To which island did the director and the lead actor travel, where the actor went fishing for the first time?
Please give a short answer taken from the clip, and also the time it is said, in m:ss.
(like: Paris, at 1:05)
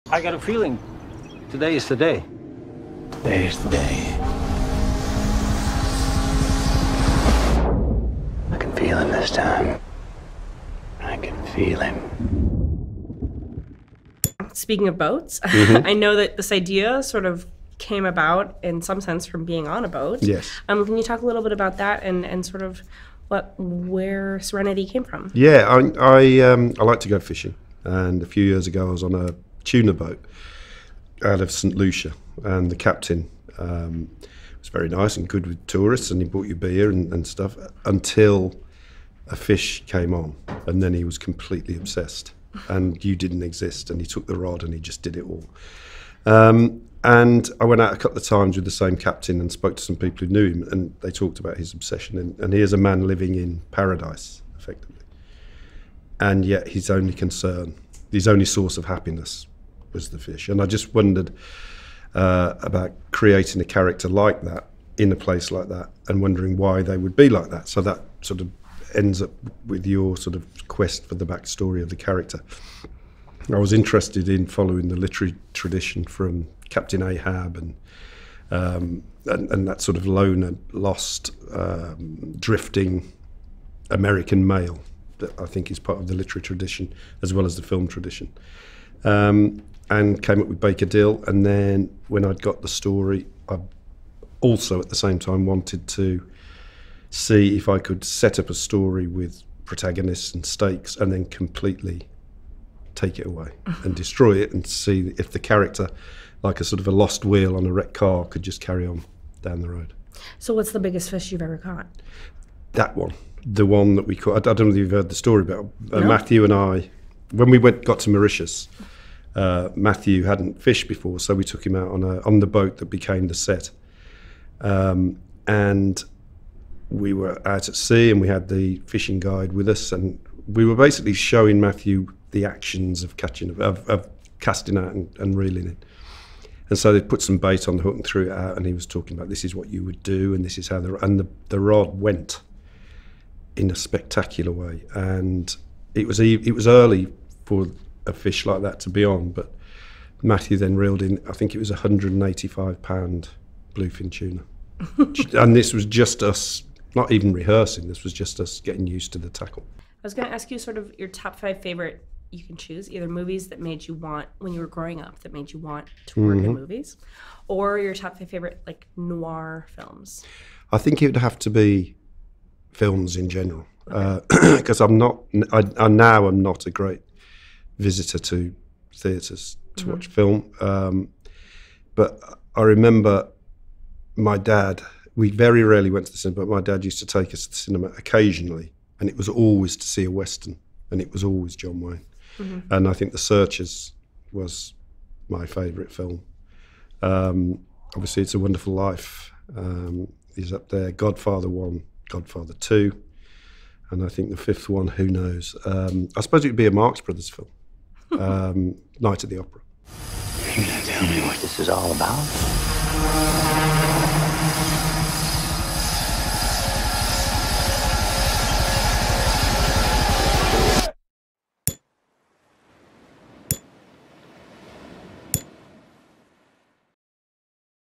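Mauritius, at 1:58.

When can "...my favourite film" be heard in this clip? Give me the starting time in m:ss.
3:15.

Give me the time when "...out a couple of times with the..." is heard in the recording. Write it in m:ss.
0:47.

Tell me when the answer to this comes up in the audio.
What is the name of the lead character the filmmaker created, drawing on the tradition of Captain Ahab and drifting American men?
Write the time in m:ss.
1:30.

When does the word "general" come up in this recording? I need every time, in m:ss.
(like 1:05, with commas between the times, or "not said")
2:53.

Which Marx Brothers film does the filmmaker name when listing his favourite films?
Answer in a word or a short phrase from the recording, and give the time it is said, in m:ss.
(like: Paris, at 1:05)
Night at the Opera, at 3:28.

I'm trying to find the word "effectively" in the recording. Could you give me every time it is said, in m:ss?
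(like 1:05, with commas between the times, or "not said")
0:54.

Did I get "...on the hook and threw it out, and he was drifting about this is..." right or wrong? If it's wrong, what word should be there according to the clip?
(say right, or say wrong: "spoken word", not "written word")
wrong: "talking", not "drifting".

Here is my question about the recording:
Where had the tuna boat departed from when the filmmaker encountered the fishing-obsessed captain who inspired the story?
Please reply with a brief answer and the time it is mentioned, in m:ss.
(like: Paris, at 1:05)
St Lucia, at 0:31.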